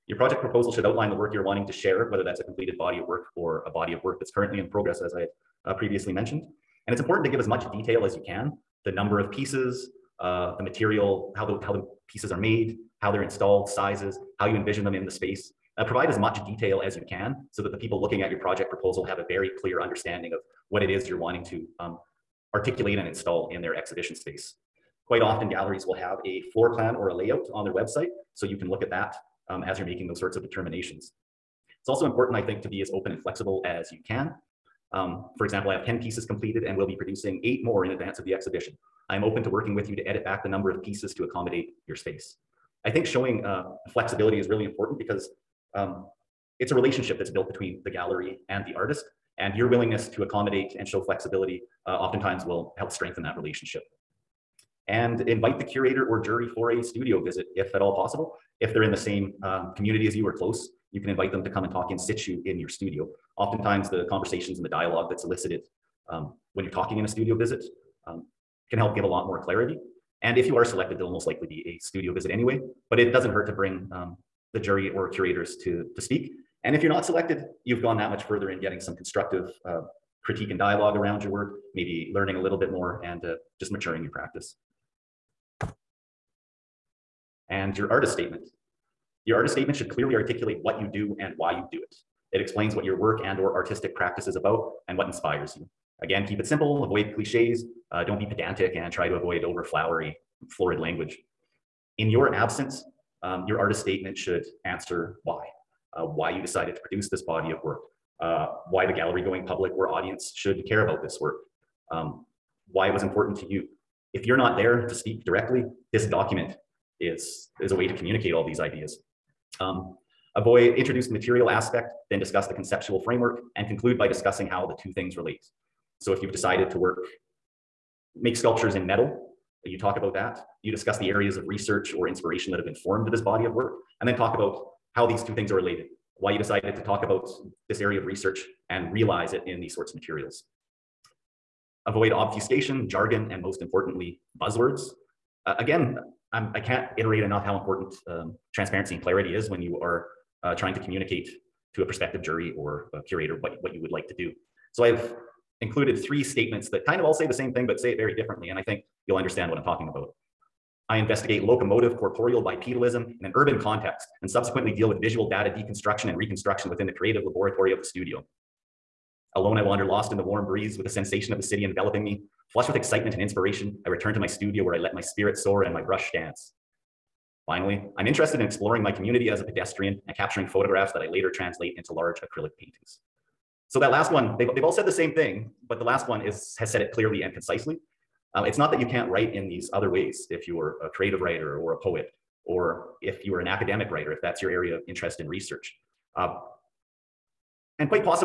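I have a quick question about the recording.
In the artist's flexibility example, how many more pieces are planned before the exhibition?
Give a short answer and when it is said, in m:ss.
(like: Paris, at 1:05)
8, at 0:37.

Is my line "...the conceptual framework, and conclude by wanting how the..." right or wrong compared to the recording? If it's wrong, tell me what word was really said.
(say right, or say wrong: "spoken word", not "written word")
wrong: "discussing", not "wanting".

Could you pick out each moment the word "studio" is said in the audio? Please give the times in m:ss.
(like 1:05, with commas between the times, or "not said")
0:56, 1:02, 1:07, 1:11, 2:47, 2:54.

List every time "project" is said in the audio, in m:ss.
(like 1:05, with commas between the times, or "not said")
0:00, 0:18.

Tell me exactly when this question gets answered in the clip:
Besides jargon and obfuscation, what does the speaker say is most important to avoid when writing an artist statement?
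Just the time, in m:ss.
2:24.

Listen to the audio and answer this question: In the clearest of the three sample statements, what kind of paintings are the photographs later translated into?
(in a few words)
Large acrylic paintings.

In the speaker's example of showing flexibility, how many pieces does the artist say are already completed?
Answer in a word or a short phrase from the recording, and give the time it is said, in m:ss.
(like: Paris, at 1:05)
10, at 0:35.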